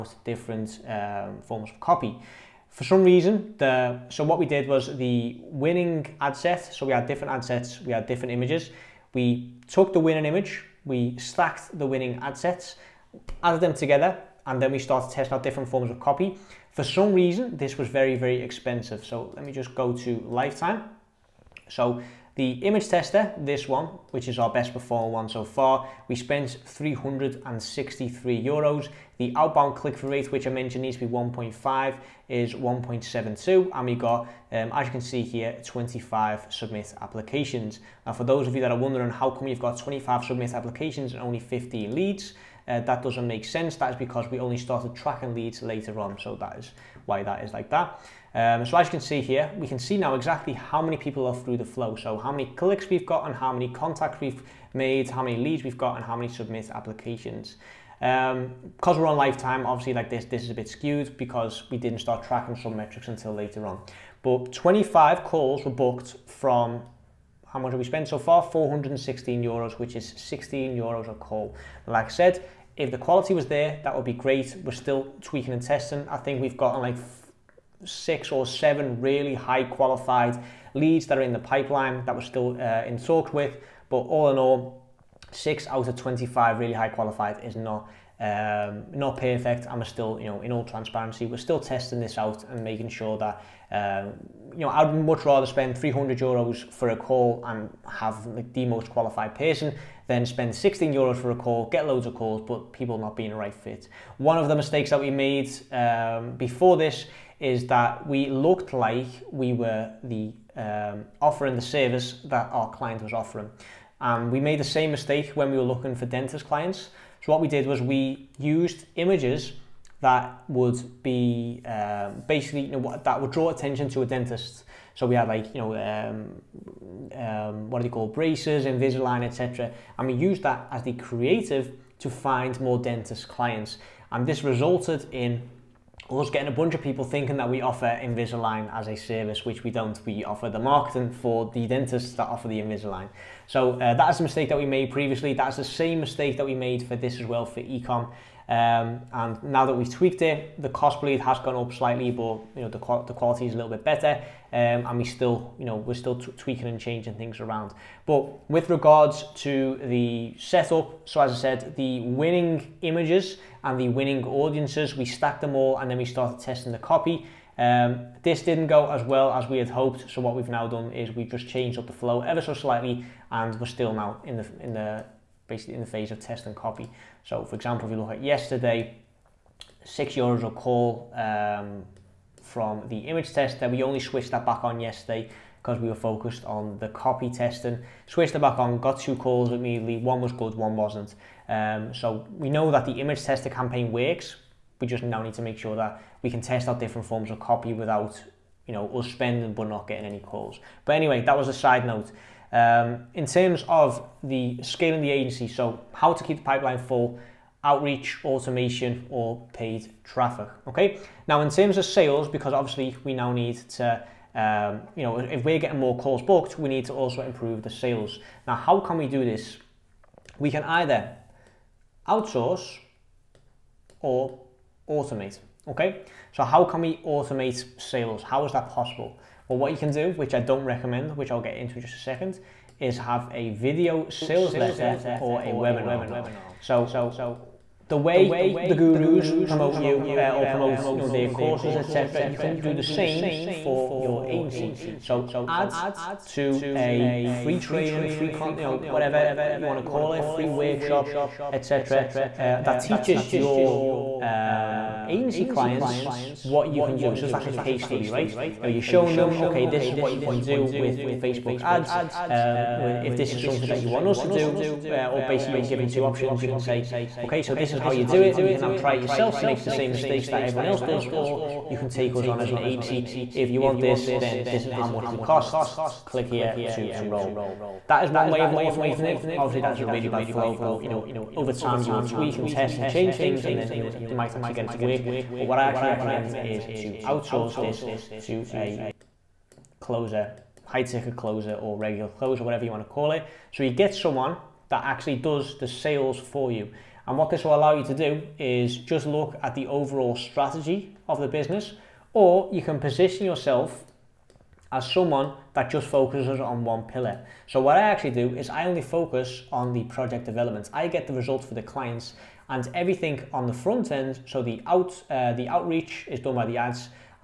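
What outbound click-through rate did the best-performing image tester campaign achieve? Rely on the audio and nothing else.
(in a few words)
1.72.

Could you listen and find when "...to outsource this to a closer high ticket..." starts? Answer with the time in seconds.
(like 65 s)
286 s.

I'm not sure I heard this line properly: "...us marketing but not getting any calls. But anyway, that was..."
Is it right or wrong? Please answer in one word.
wrong.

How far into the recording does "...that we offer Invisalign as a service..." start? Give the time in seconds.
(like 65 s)
137 s.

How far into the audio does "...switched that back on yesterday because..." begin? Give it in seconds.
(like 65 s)
184 s.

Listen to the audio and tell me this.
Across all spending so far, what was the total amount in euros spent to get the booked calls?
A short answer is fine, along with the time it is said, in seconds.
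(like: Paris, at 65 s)
416 euros, at 68 s.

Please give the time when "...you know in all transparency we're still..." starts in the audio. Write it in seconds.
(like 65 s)
90 s.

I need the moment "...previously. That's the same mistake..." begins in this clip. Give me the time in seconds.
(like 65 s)
144 s.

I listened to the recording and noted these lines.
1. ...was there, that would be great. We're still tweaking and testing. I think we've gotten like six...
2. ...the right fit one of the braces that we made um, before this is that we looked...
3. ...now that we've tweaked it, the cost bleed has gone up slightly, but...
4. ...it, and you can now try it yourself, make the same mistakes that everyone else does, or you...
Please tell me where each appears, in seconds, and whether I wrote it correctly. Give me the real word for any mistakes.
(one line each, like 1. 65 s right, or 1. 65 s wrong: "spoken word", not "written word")
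1. 73 s right
2. 103 s wrong: "mistakes", not "braces"
3. 149 s right
4. 268 s right.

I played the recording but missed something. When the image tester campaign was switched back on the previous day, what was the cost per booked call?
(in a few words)
6 euros.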